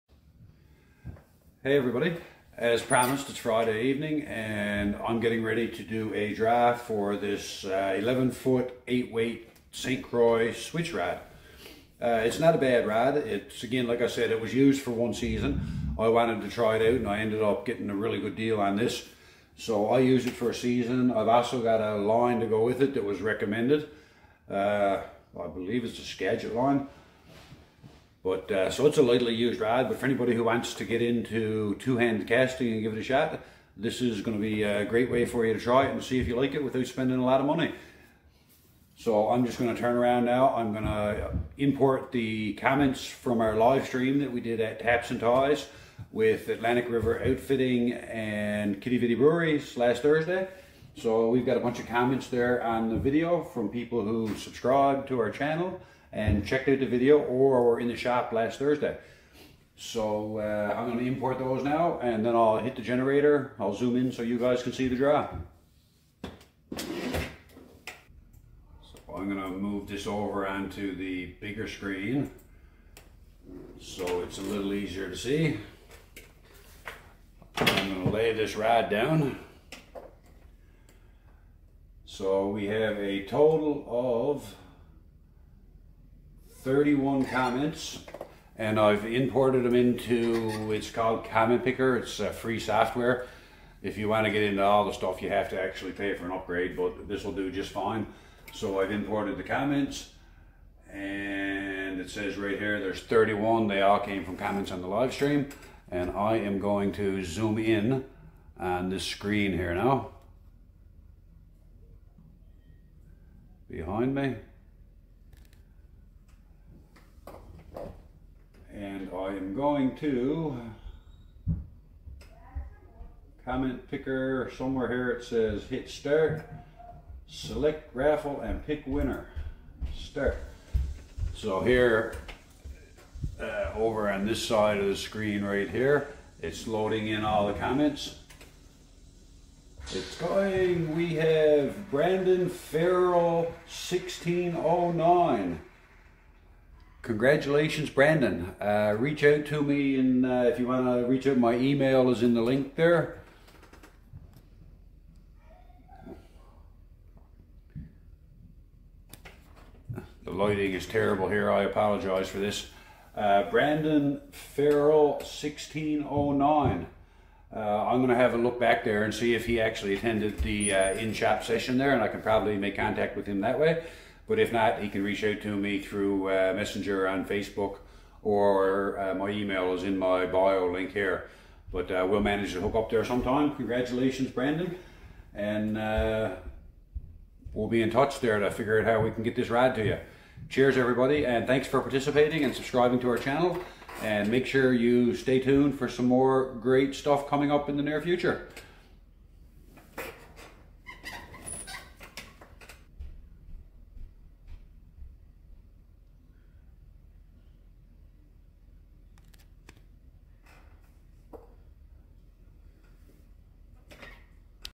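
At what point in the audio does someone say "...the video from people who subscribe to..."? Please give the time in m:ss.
0:52.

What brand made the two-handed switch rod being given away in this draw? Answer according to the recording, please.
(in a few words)
St. Croix.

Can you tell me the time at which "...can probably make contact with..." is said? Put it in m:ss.
2:52.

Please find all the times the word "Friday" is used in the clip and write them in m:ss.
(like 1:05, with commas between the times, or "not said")
0:03.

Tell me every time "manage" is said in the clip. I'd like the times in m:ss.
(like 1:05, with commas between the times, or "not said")
3:02.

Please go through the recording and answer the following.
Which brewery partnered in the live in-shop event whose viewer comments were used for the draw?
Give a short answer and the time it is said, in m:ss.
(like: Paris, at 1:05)
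Quidi Vidi Breweries, at 0:48.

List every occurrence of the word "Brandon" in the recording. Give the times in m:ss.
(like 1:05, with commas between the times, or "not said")
2:21, 2:27, 2:43, 3:04.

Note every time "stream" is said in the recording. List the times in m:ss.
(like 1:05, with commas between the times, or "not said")
0:43, 1:45.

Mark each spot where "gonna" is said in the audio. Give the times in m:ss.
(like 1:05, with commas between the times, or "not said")
1:00, 1:09, 1:17.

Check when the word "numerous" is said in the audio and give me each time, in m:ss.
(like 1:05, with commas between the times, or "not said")
not said.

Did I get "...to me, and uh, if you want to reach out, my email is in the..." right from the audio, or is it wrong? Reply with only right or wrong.
right.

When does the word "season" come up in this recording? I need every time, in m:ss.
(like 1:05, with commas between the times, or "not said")
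0:15, 0:20.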